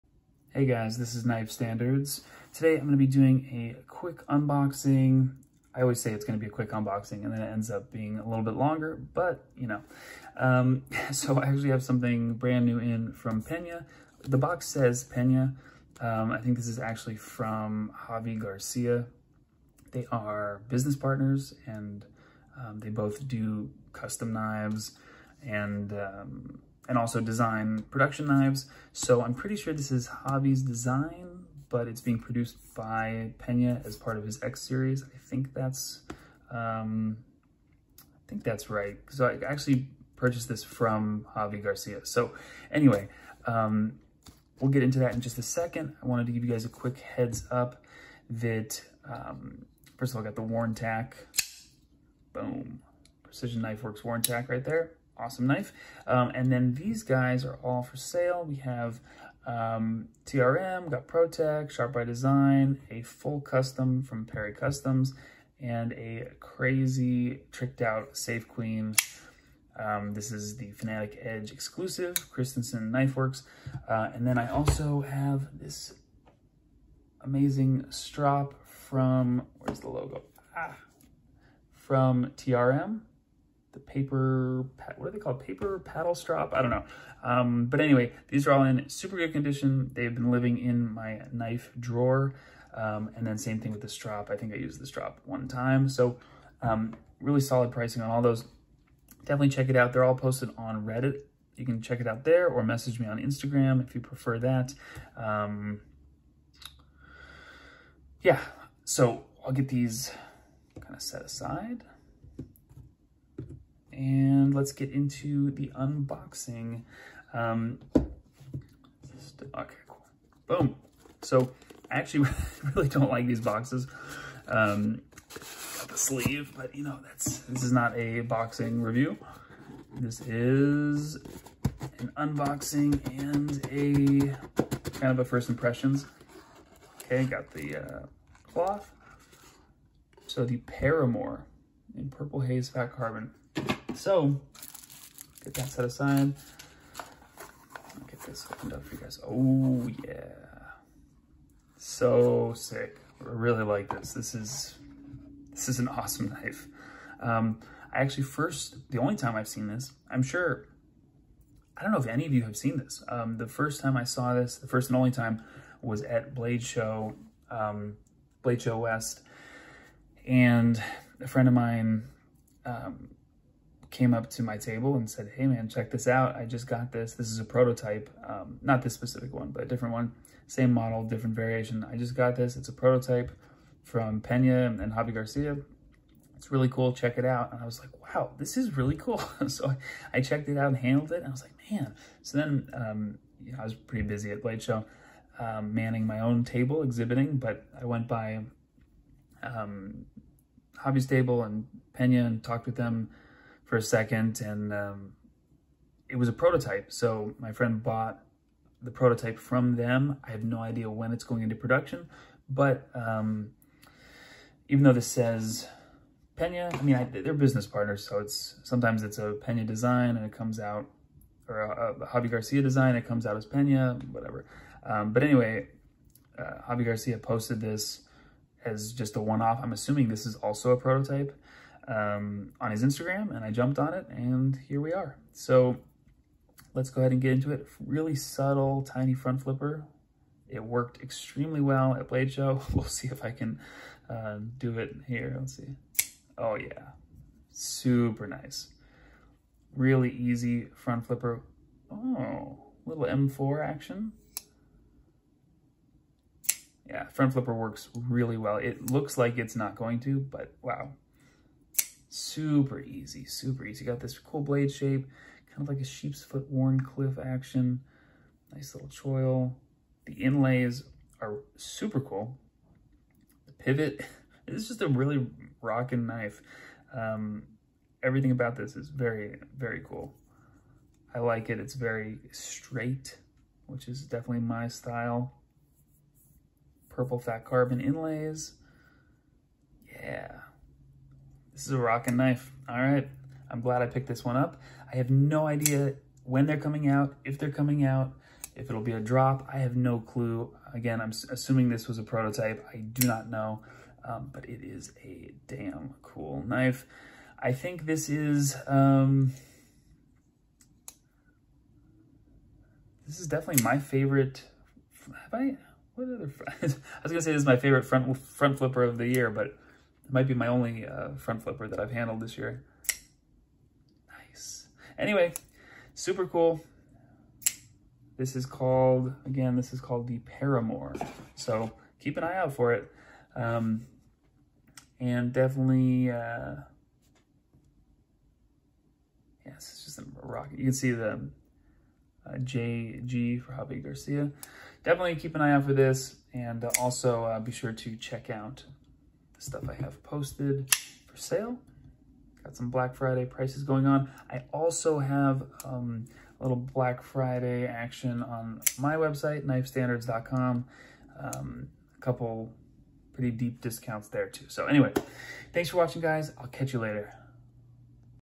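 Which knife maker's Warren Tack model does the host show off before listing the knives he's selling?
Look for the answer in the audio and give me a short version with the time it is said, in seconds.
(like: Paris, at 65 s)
Precision Knife Works, at 53 s.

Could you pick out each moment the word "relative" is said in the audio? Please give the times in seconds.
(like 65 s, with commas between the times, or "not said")
not said.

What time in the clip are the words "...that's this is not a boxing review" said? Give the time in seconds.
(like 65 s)
127 s.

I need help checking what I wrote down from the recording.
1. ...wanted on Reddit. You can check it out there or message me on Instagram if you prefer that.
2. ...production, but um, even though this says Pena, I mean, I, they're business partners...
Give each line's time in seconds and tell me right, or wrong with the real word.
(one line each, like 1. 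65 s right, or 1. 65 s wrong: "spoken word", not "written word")
1. 100 s wrong: "posted", not "wanted"
2. 211 s right.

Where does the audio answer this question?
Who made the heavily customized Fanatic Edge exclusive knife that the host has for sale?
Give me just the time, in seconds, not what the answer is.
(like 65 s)
72 s.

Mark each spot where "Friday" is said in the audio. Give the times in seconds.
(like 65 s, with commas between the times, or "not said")
352 s, 357 s.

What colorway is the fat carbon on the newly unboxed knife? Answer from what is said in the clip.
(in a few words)
Purple Haze.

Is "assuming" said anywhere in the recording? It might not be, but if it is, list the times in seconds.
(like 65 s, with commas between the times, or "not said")
229 s, 301 s.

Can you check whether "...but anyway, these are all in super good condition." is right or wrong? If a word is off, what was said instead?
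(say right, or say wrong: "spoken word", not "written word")
right.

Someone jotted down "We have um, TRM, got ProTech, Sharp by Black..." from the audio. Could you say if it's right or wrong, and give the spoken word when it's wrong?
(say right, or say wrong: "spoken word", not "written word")
wrong: "Design", not "Black".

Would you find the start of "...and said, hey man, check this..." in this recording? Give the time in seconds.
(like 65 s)
174 s.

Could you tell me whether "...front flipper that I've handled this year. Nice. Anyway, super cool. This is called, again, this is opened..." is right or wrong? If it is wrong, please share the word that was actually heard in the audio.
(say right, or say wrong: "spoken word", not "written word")
wrong: "called", not "opened".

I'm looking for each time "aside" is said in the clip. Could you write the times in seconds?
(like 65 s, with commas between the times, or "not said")
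111 s, 145 s.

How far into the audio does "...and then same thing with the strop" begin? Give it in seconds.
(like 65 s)
93 s.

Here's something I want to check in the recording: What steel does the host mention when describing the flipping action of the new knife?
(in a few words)
M4.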